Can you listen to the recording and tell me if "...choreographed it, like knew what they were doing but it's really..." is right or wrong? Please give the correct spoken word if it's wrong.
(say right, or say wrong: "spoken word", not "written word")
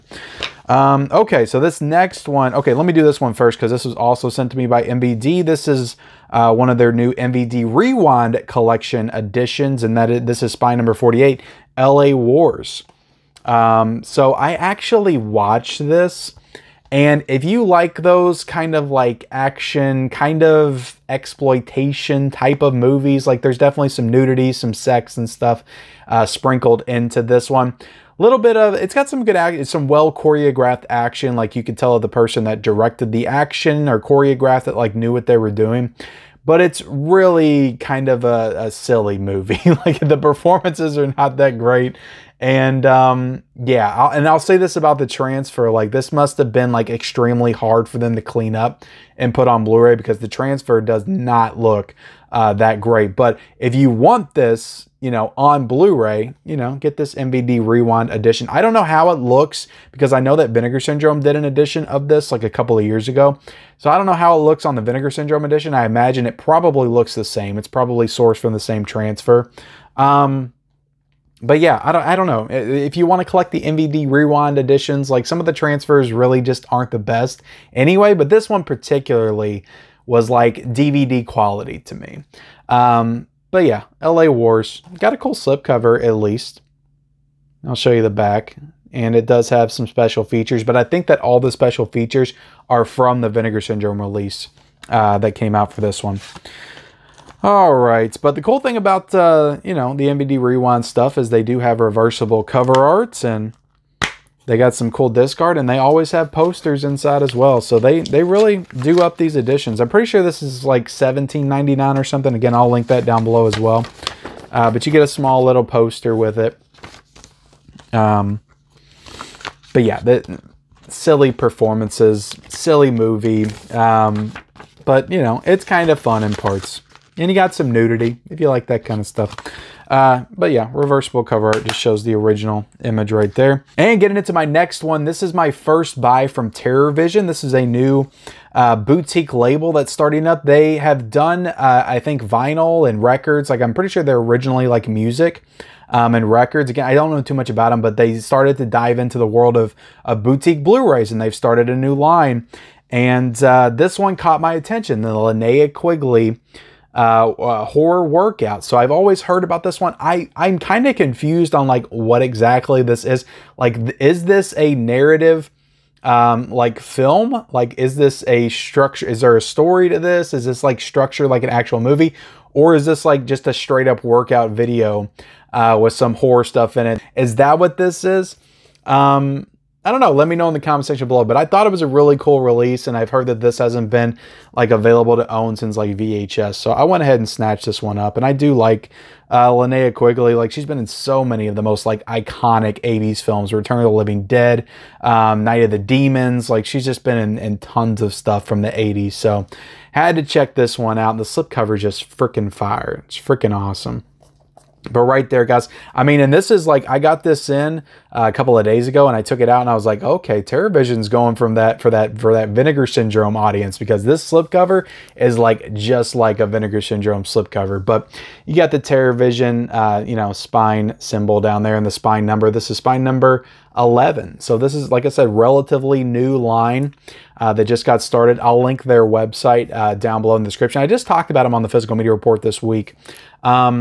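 right.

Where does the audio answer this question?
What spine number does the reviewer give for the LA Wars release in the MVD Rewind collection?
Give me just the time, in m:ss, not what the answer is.
0:10.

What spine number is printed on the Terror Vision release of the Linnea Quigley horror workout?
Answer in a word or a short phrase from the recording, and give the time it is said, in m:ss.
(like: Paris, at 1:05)
11, at 3:42.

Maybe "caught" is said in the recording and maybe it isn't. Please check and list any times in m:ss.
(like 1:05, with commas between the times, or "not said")
2:34.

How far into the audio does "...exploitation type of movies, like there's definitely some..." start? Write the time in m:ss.
0:21.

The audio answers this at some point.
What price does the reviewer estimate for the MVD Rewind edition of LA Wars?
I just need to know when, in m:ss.
1:50.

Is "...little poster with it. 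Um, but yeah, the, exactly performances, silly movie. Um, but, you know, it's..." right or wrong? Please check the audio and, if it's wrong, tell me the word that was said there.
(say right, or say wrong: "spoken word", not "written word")
wrong: "silly", not "exactly".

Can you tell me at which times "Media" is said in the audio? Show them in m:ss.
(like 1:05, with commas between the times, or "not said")
3:51.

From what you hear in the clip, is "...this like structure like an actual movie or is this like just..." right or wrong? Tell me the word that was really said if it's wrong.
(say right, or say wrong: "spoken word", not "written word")
right.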